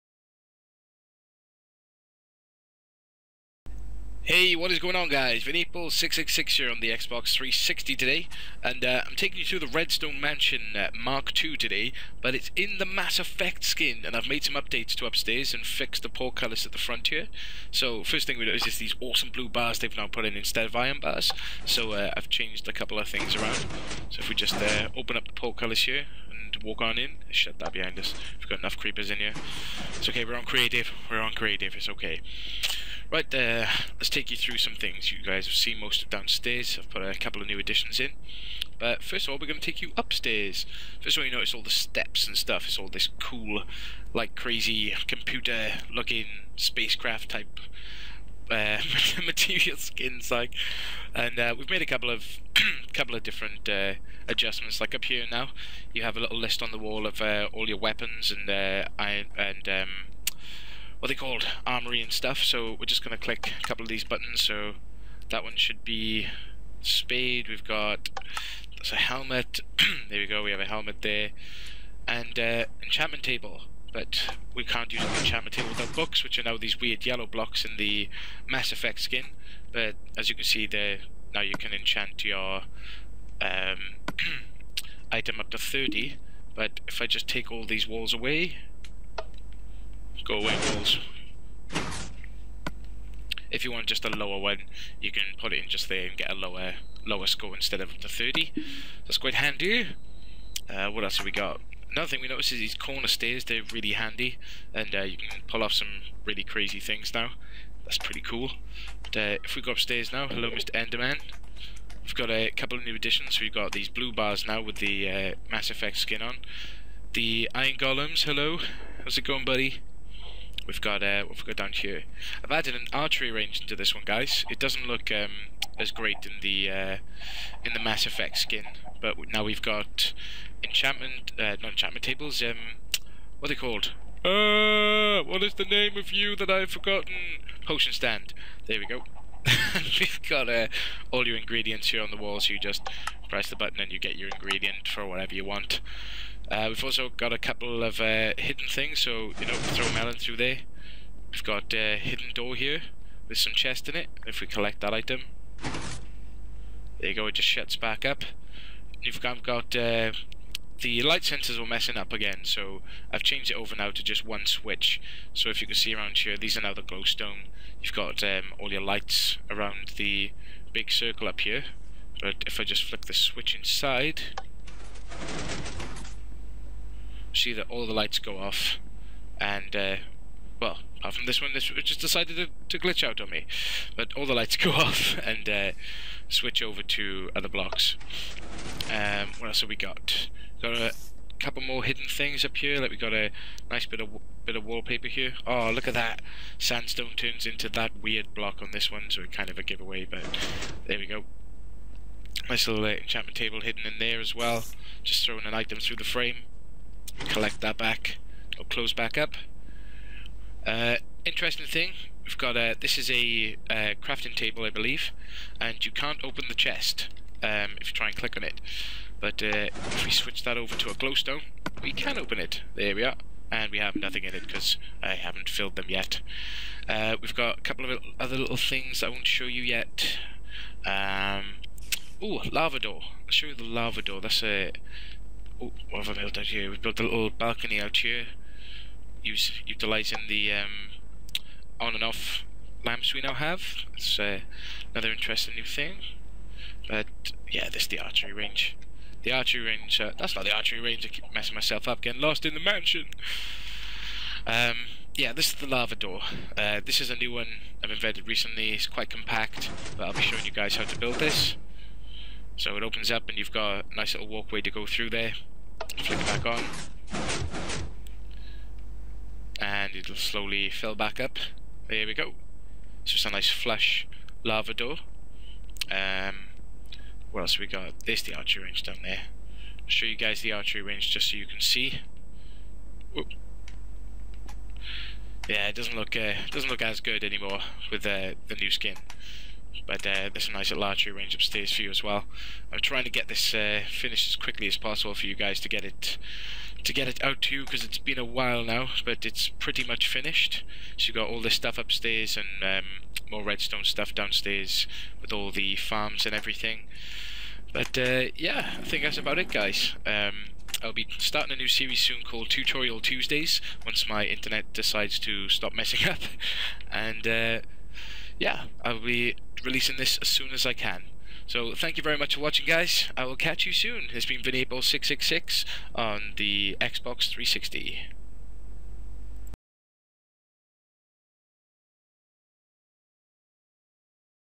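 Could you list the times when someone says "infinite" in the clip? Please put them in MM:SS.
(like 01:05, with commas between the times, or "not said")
not said.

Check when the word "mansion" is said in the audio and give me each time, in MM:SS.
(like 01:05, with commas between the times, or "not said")
00:10, 04:12.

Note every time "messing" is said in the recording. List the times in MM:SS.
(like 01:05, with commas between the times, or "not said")
02:41, 04:11, 05:15.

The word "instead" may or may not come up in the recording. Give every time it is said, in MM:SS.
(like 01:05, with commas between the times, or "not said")
00:20, 01:37.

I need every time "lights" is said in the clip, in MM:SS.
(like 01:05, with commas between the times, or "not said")
02:41, 02:48, 02:57, 03:04.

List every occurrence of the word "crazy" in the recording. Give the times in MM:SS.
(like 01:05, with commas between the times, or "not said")
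00:44, 01:46.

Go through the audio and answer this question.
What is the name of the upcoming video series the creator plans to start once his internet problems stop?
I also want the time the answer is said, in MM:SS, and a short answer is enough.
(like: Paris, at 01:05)
Tutorial Tuesdays, at 05:12.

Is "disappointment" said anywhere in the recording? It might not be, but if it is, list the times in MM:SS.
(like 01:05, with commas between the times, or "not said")
not said.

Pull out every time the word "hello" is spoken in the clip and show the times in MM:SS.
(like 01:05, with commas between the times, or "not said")
01:50, 01:58.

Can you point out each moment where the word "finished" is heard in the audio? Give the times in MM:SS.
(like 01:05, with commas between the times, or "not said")
04:53, 05:00.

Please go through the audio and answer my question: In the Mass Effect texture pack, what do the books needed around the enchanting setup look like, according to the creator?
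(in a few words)
Weird yellow blocks.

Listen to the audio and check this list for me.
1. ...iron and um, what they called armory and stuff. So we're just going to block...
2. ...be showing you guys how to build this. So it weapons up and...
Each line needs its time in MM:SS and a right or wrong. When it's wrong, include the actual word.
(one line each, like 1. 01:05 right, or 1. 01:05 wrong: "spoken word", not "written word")
1. 00:58 wrong: "click", not "block"
2. 04:20 wrong: "opens", not "weapons".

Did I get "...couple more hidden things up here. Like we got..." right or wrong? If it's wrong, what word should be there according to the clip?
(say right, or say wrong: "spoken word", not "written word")
right.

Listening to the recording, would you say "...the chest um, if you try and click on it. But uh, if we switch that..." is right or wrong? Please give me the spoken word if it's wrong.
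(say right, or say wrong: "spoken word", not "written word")
right.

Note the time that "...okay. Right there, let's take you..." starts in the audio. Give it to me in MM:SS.
00:31.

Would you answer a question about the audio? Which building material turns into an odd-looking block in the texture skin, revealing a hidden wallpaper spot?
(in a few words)
Sandstone.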